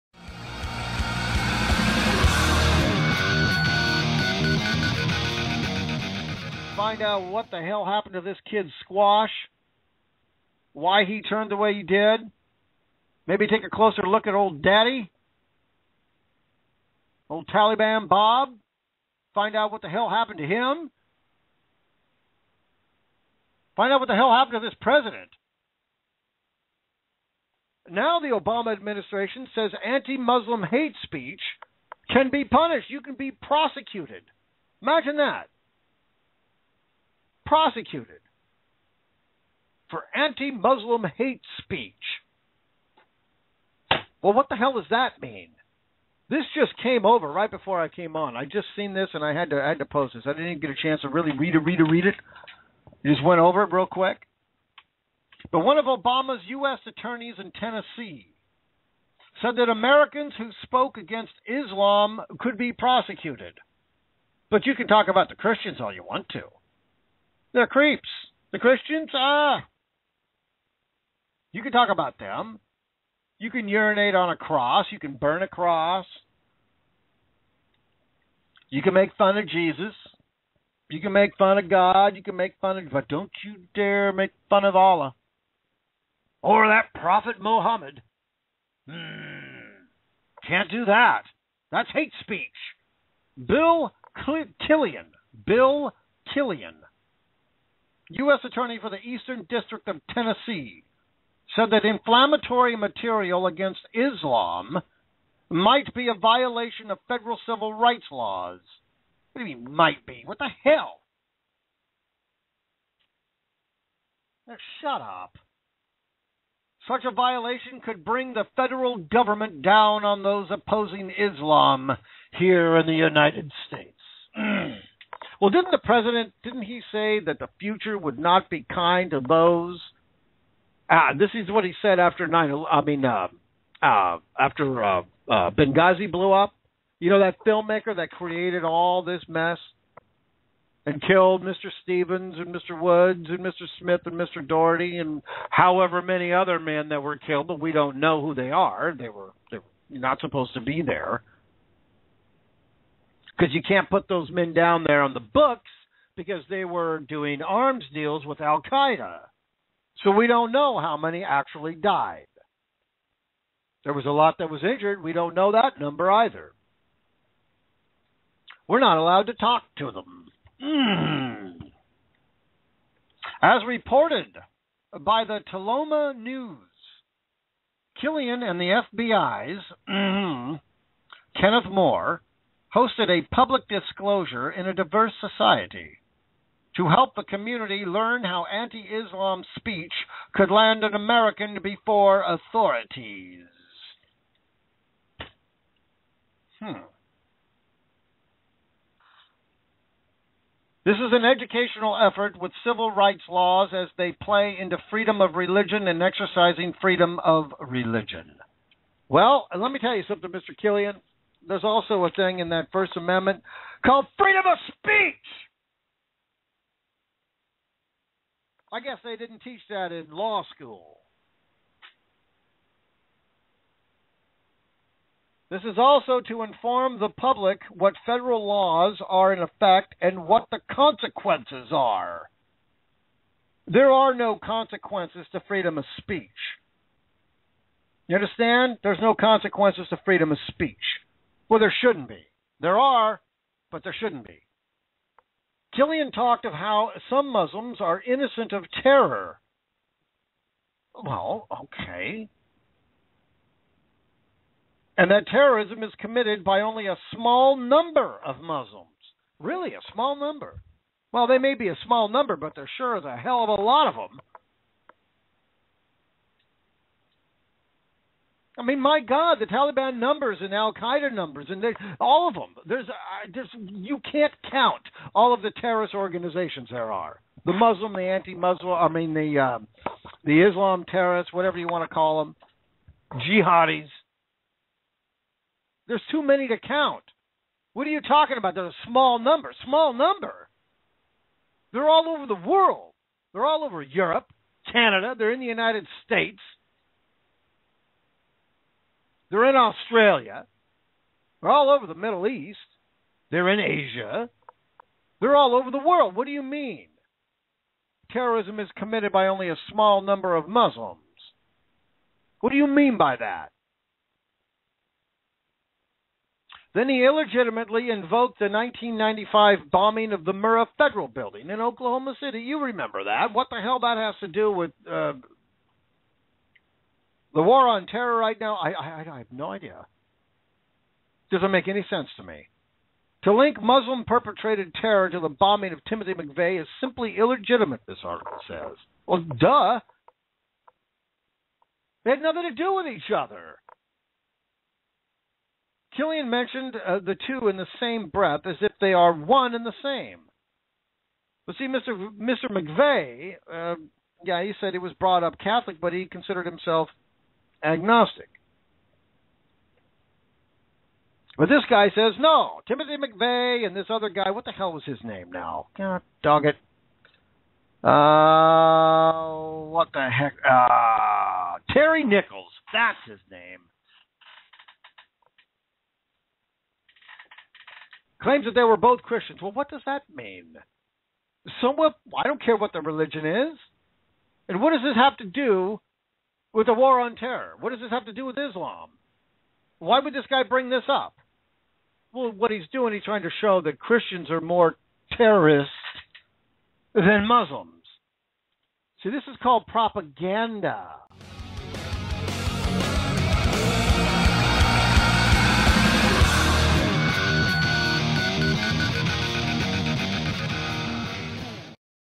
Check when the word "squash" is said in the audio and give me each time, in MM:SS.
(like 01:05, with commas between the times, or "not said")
00:08.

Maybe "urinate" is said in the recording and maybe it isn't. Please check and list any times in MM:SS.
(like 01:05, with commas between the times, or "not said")
01:13.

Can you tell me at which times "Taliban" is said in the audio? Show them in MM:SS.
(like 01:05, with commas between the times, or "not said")
00:17, 04:29.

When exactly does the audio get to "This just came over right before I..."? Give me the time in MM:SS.
00:46.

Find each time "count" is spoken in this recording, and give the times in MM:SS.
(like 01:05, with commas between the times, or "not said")
04:34, 04:46.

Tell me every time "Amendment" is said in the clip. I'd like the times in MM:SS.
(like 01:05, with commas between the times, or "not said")
03:32.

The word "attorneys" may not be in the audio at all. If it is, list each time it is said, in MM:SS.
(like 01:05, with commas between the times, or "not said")
00:56, 01:38.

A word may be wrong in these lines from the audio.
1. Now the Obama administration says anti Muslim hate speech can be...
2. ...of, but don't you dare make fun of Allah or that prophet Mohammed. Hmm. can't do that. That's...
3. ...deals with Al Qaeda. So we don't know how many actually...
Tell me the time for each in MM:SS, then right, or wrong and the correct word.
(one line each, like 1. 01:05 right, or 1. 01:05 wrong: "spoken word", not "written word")
1. 00:27 right
2. 01:22 right
3. 02:37 right.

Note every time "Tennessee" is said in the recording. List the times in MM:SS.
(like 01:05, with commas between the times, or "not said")
00:57, 01:40.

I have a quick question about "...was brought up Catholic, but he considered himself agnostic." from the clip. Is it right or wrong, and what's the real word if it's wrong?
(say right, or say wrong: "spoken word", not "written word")
right.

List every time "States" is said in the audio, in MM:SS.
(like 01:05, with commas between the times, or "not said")
02:03, 04:56.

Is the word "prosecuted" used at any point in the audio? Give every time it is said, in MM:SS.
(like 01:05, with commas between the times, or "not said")
00:33, 00:37, 01:02.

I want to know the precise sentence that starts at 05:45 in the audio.
Killian mentioned uh, the two in the same breath as if they are one and the same.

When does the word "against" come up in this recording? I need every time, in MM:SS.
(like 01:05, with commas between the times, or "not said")
01:00, 01:43.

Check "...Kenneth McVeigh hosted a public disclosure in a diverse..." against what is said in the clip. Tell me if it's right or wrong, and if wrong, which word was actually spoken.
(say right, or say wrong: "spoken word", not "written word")
wrong: "Moore", not "McVeigh".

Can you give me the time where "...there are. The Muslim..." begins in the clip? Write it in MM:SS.
04:36.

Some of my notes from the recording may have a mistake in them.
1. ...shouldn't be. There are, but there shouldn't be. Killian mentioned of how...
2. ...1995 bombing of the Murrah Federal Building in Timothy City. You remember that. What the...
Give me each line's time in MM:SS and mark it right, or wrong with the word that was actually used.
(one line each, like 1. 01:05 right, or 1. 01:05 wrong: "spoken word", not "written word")
1. 04:01 wrong: "talked", not "mentioned"
2. 05:18 wrong: "Oklahoma", not "Timothy".